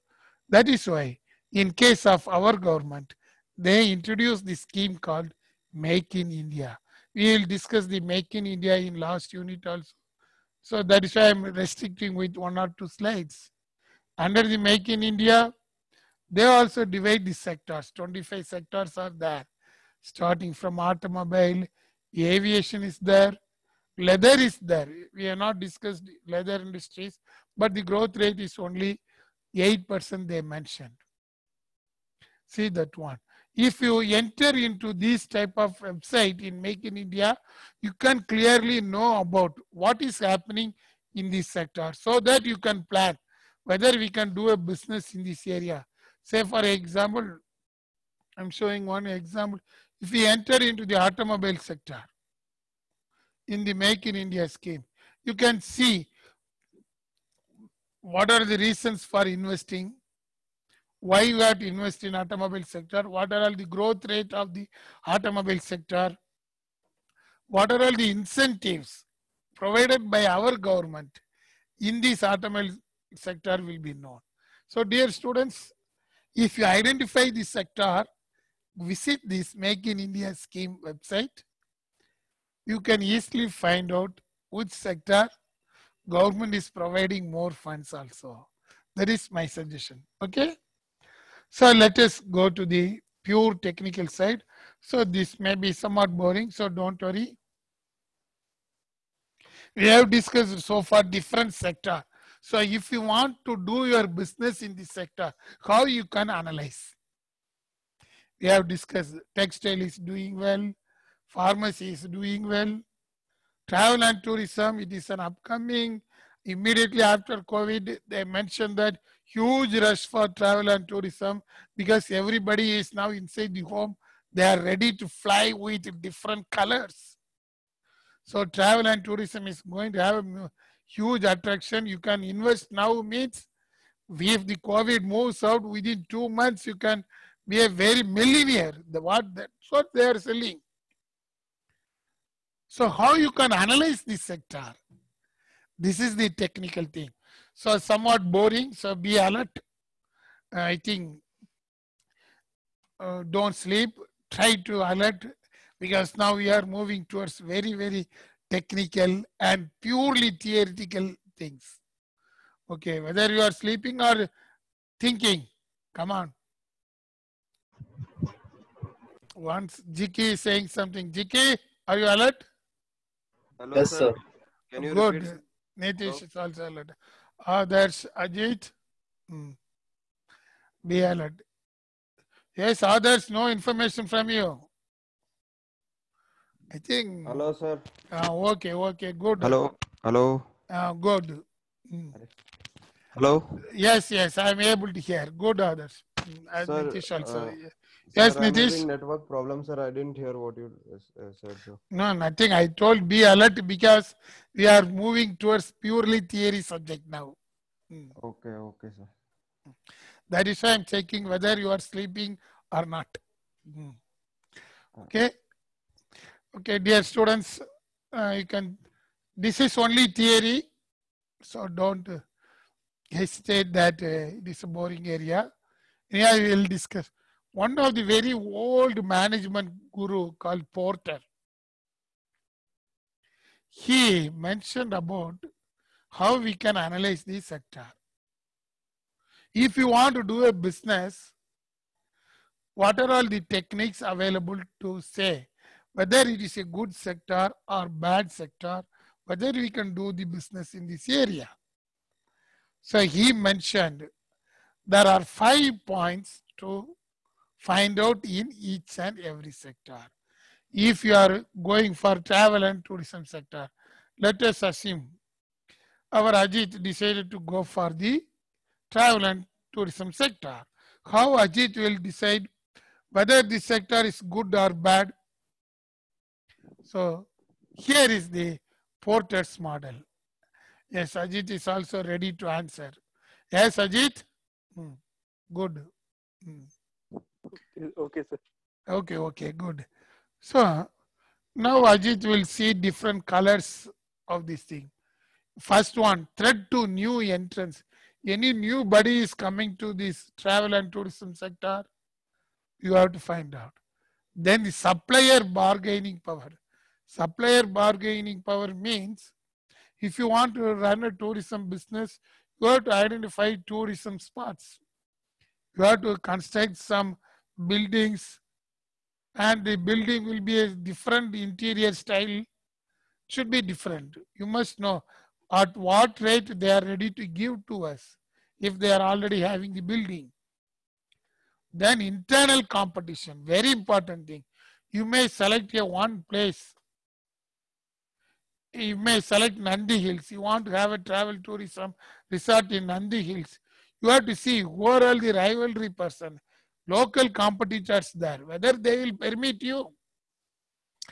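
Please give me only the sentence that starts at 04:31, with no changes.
How Ajit will decide whether this sector is good or bad?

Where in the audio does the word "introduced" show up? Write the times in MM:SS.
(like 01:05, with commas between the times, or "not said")
00:03.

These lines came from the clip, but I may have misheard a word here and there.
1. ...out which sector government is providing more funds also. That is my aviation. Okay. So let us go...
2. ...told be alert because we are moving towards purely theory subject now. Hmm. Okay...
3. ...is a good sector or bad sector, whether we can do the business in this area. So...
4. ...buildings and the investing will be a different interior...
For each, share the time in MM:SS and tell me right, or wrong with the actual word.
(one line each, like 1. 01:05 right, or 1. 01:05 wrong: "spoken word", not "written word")
1. 01:23 wrong: "suggestion", not "aviation"
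2. 03:22 right
3. 04:06 right
4. 05:17 wrong: "building", not "investing".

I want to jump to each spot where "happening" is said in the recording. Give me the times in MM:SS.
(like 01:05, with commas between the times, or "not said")
00:40.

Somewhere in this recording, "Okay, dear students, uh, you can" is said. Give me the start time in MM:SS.
03:36.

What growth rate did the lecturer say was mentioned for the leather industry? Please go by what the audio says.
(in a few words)
8%.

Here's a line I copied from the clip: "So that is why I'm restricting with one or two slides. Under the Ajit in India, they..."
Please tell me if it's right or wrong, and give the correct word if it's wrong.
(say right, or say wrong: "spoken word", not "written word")
wrong: "Make", not "Ajit".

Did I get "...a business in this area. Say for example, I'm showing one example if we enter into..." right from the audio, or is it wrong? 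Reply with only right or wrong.
right.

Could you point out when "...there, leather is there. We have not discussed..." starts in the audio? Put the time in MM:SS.
00:22.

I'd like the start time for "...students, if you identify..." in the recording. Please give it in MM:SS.
01:15.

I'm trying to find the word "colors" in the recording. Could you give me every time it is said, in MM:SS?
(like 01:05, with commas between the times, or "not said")
02:06, 04:53.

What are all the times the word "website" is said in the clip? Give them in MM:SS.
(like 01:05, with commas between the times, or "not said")
00:35, 01:20.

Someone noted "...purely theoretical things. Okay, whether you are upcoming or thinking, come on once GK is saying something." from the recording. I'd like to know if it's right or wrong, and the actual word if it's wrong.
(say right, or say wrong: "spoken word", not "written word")
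wrong: "sleeping", not "upcoming".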